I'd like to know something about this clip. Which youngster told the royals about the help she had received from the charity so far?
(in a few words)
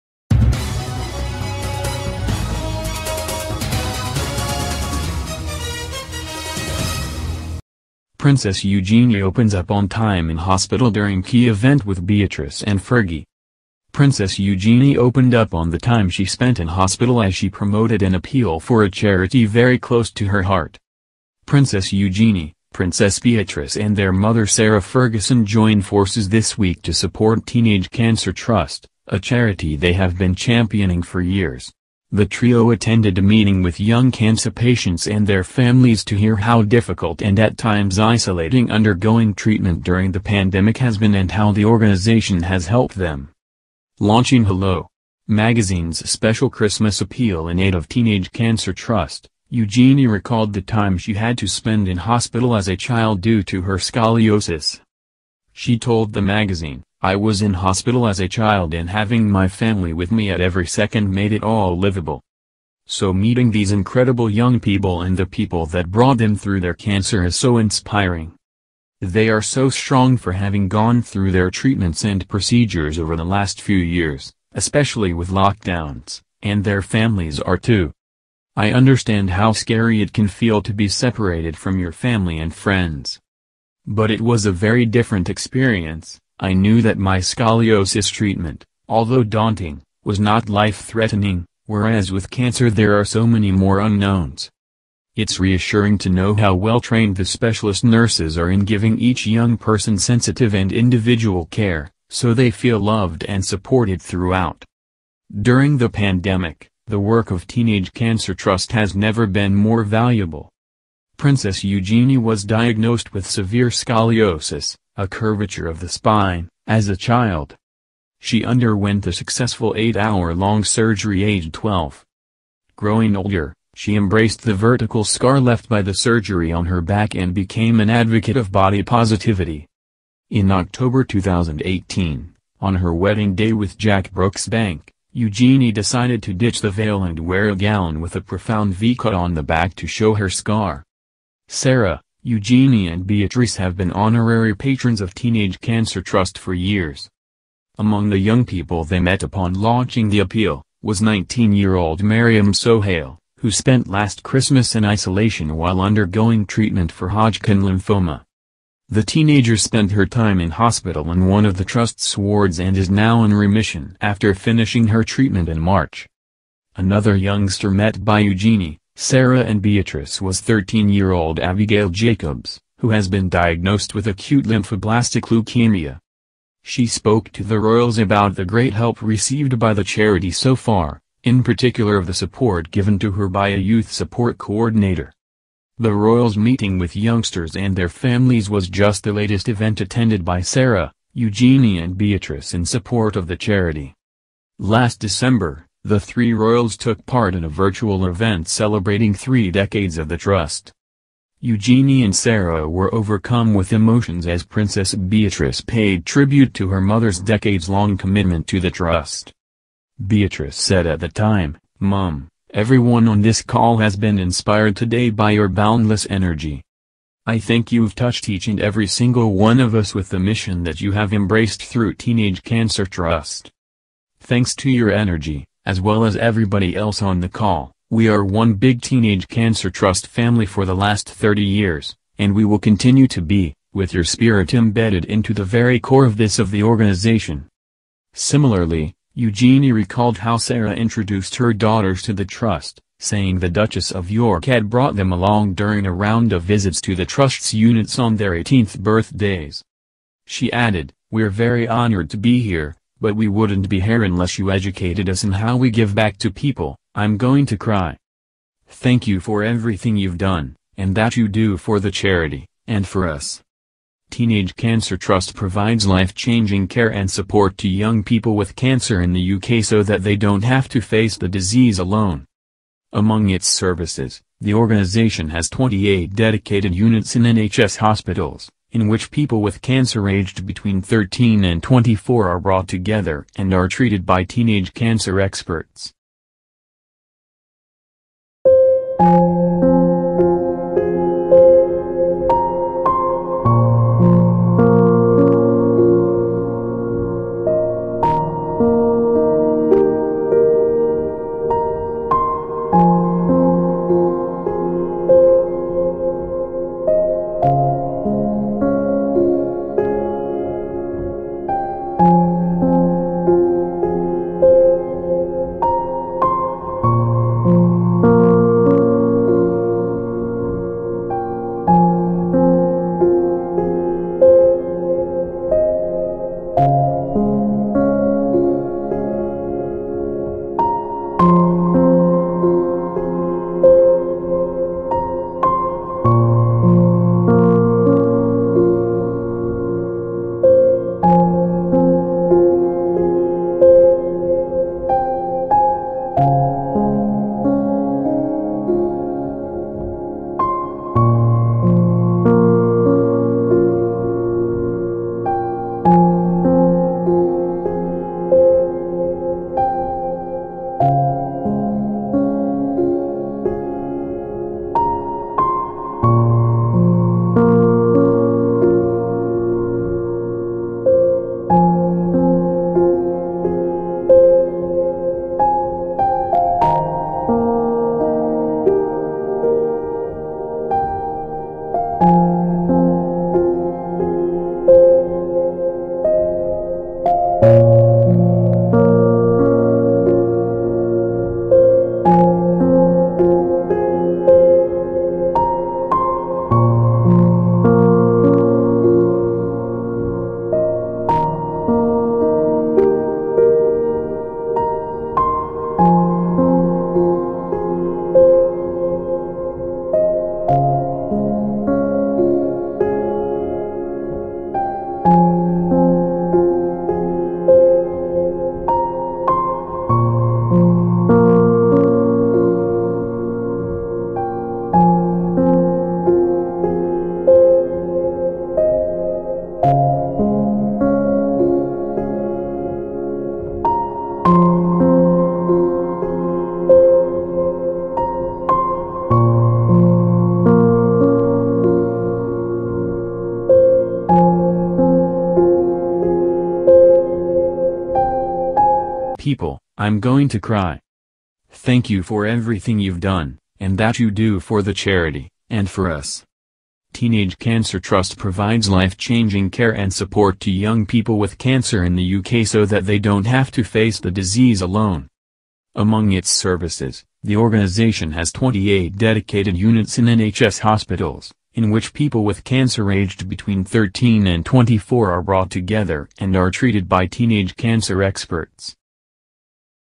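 Abigail Jacobs.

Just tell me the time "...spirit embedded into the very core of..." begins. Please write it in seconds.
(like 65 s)
234 s.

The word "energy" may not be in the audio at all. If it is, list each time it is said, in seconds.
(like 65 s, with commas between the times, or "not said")
216 s, 224 s.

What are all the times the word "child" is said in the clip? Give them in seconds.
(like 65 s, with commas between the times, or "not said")
52 s, 58 s, 116 s.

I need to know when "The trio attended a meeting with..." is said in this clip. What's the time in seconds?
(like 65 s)
32 s.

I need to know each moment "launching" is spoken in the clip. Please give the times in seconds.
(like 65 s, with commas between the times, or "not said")
44 s, 149 s.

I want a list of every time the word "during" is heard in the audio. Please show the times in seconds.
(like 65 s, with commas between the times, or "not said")
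10 s, 39 s, 105 s, 245 s.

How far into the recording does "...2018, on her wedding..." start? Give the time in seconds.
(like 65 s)
131 s.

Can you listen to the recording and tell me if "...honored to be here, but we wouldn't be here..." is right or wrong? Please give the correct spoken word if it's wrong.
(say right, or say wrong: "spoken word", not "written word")
right.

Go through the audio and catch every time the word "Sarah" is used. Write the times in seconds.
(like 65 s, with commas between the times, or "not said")
24 s, 141 s, 169 s, 190 s, 202 s, 240 s.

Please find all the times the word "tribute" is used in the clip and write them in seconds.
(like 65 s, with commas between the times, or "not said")
206 s.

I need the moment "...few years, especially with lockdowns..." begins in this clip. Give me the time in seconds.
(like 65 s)
73 s.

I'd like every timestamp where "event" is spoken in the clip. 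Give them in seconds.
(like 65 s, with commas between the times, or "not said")
11 s, 189 s, 198 s.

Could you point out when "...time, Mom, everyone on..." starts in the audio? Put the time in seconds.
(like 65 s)
211 s.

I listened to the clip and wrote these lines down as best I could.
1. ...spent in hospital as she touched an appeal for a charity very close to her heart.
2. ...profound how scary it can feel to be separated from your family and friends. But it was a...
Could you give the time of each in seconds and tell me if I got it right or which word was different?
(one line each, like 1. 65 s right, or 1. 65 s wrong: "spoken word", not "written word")
1. 16 s wrong: "promoted", not "touched"
2. 78 s wrong: "understand", not "profound".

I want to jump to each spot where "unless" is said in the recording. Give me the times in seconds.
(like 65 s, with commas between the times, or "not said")
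254 s.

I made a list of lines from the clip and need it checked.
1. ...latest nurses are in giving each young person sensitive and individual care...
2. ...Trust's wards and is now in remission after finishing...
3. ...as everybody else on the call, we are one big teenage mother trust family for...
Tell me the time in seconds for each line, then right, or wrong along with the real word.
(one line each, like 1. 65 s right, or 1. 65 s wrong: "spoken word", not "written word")
1. 97 s wrong: "specialist", not "latest"
2. 161 s right
3. 226 s wrong: "cancer", not "mother".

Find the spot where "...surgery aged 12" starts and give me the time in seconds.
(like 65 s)
120 s.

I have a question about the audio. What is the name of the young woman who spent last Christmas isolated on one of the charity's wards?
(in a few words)
Mariam Sohail.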